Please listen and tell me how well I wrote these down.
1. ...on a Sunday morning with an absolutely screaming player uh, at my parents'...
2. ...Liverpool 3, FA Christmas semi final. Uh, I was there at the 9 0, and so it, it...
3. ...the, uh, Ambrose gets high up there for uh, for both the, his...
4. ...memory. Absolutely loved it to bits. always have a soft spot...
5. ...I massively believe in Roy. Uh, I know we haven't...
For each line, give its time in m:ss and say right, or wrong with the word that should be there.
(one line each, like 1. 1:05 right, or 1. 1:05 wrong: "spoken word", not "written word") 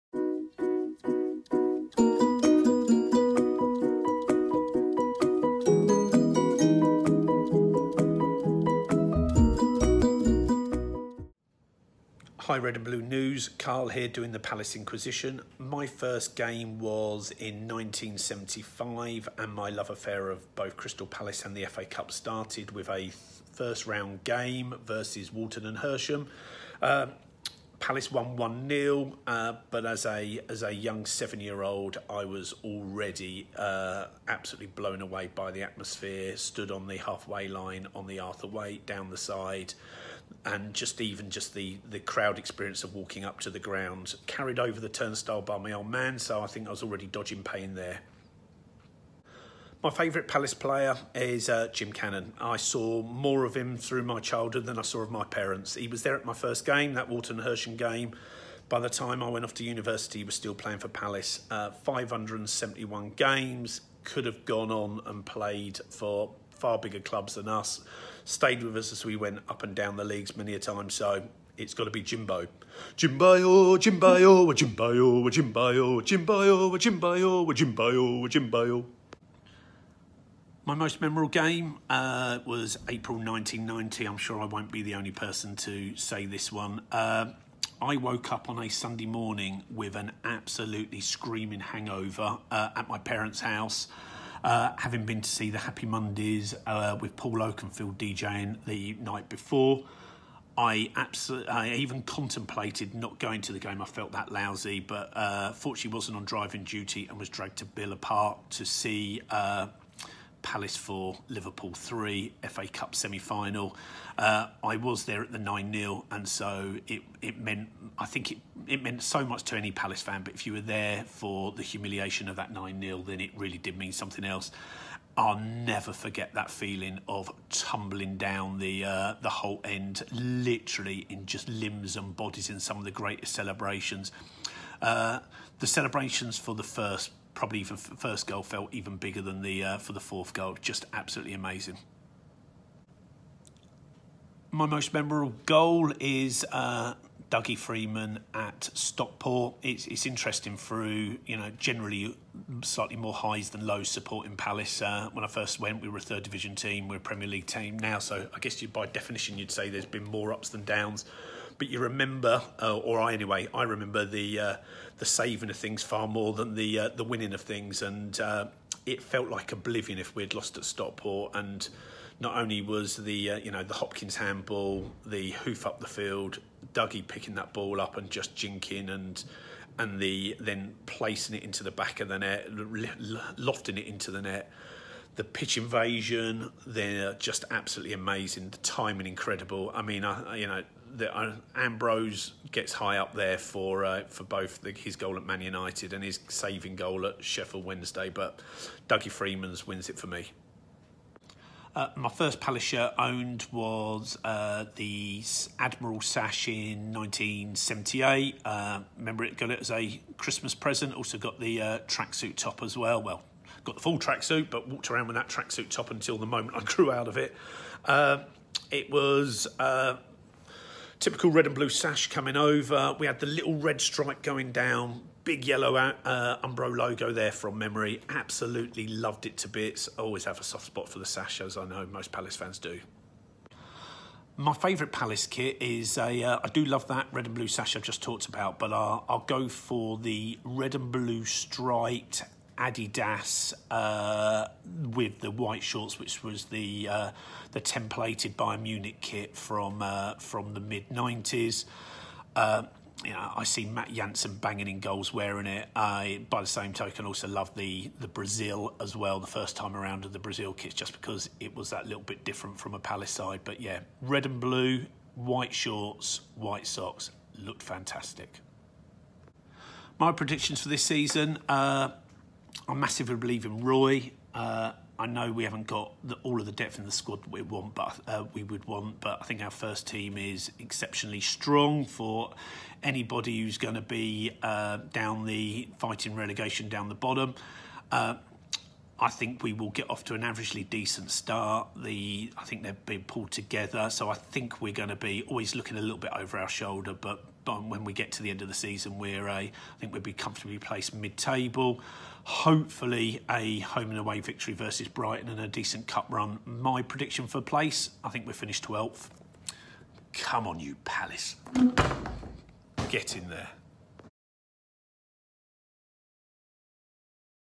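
1. 1:28 wrong: "hangover", not "player"
2. 1:51 wrong: "Cup", not "Christmas"
3. 3:10 right
4. 3:47 right
5. 4:32 right.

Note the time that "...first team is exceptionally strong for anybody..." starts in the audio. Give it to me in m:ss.
4:39.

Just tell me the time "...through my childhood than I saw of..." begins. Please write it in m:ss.
0:53.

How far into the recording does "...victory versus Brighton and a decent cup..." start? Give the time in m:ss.
5:04.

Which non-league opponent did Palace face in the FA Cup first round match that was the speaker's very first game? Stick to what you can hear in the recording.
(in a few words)
Walton and Hersham.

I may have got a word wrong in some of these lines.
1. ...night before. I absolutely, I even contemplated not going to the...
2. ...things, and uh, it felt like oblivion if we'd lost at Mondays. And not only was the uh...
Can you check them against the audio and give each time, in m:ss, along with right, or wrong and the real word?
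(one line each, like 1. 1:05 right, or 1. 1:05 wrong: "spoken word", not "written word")
1. 1:38 right
2. 2:47 wrong: "Stockport", not "Mondays".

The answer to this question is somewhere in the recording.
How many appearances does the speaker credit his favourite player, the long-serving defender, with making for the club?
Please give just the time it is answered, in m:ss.
1:01.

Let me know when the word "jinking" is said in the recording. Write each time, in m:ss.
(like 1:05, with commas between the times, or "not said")
2:58.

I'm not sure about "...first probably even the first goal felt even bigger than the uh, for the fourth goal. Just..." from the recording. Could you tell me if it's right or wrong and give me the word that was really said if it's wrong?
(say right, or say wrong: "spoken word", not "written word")
right.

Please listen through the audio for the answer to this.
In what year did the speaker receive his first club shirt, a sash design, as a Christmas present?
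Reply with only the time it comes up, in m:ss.
3:26.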